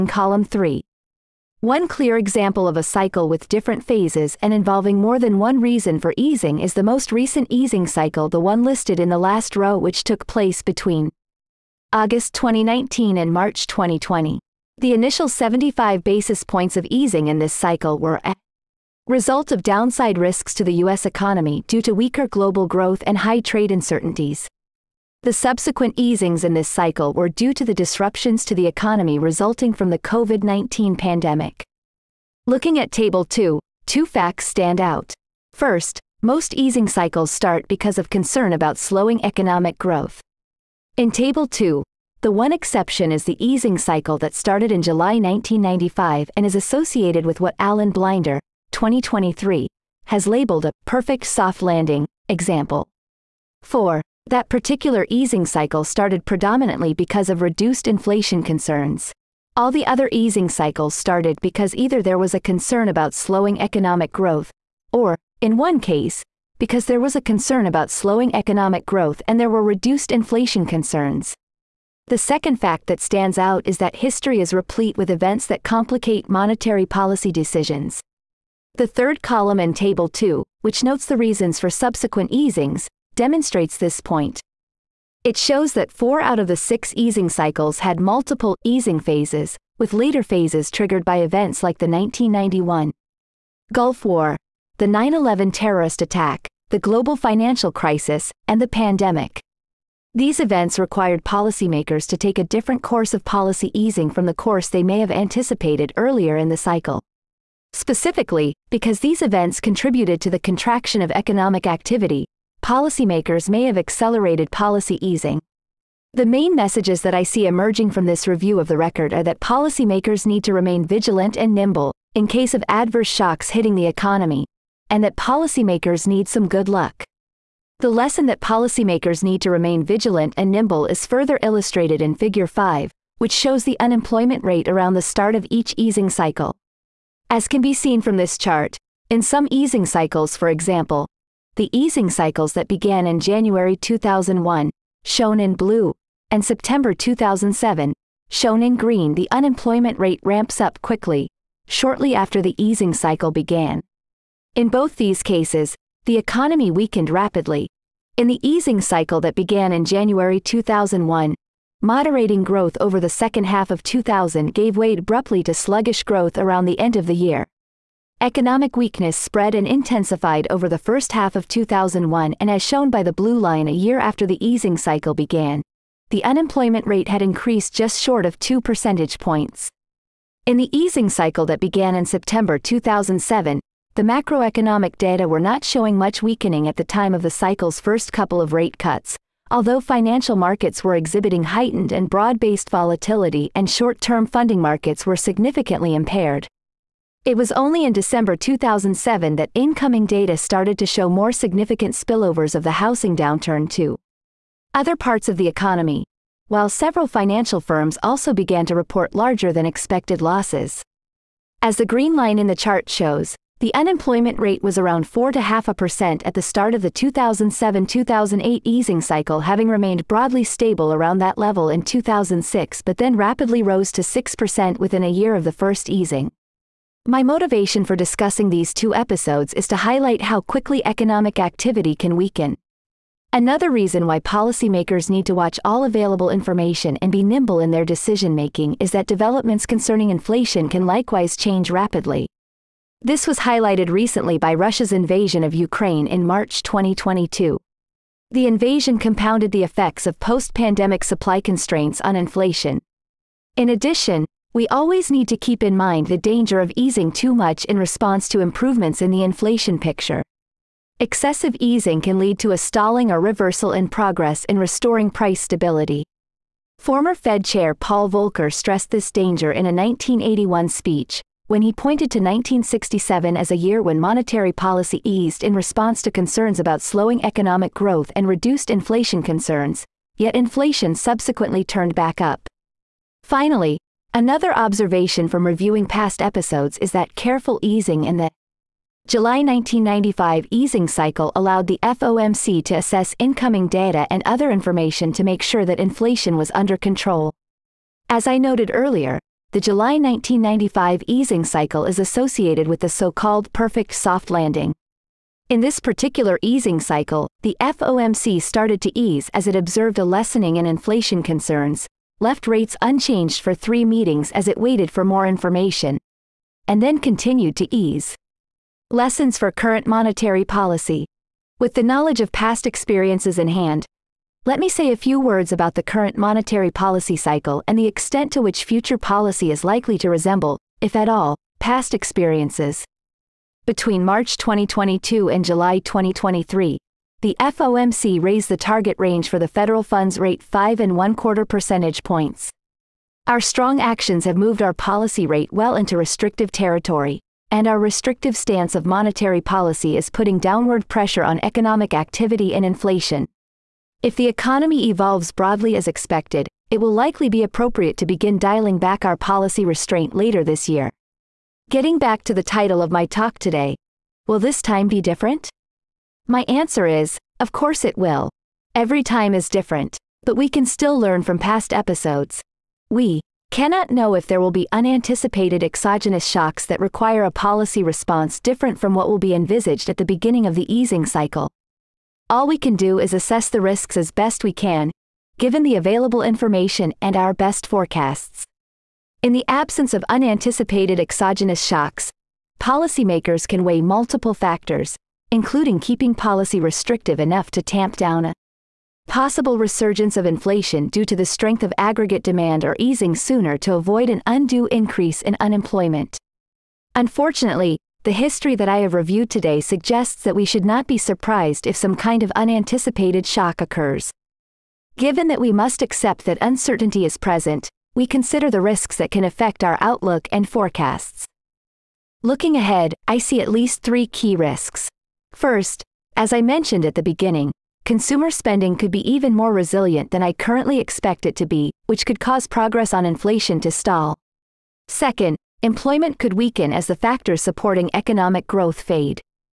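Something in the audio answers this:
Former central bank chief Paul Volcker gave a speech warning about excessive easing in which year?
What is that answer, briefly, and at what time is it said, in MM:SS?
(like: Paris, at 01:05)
1981, at 04:29.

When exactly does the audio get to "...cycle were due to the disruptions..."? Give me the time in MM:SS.
00:26.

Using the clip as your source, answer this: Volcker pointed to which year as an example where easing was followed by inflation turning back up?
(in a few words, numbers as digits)
1967.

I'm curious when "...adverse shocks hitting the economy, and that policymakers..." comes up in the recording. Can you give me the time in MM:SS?
02:02.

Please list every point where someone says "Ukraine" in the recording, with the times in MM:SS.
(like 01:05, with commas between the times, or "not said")
04:05.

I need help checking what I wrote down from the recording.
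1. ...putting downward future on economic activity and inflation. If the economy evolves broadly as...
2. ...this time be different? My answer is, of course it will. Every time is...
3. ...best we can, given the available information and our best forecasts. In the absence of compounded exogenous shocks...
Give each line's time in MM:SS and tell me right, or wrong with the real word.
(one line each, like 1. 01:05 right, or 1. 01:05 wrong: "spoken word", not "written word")
1. 05:50 wrong: "pressure", not "future"
2. 06:04 right
3. 06:24 wrong: "unanticipated", not "compounded".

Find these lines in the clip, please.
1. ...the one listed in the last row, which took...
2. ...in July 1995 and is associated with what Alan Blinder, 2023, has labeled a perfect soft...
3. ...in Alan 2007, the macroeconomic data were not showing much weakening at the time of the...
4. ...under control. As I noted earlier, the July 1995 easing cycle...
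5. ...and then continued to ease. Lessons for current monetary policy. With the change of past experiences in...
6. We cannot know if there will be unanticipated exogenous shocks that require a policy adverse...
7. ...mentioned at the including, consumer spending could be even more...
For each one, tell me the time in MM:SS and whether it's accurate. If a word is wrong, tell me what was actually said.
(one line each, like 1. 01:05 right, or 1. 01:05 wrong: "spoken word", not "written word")
1. 00:08 right
2. 00:44 right
3. 03:01 wrong: "September", not "Alan"
4. 04:56 right
5. 05:16 wrong: "knowledge", not "change"
6. 06:12 wrong: "response", not "adverse"
7. 07:06 wrong: "beginning", not "including".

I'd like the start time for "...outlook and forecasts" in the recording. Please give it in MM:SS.
06:59.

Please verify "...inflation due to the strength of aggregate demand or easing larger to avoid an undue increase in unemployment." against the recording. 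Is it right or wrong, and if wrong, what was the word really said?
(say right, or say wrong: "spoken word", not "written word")
wrong: "sooner", not "larger".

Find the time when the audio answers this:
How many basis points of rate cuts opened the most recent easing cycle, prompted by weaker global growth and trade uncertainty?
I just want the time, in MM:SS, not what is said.
00:15.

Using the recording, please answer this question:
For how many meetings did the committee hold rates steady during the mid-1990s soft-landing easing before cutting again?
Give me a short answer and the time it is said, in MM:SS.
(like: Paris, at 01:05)
3, at 05:13.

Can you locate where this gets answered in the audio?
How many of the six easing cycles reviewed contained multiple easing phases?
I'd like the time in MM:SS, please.
01:25.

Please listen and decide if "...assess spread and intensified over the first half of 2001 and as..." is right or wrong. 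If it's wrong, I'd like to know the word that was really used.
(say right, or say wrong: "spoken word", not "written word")
wrong: "weakness", not "assess".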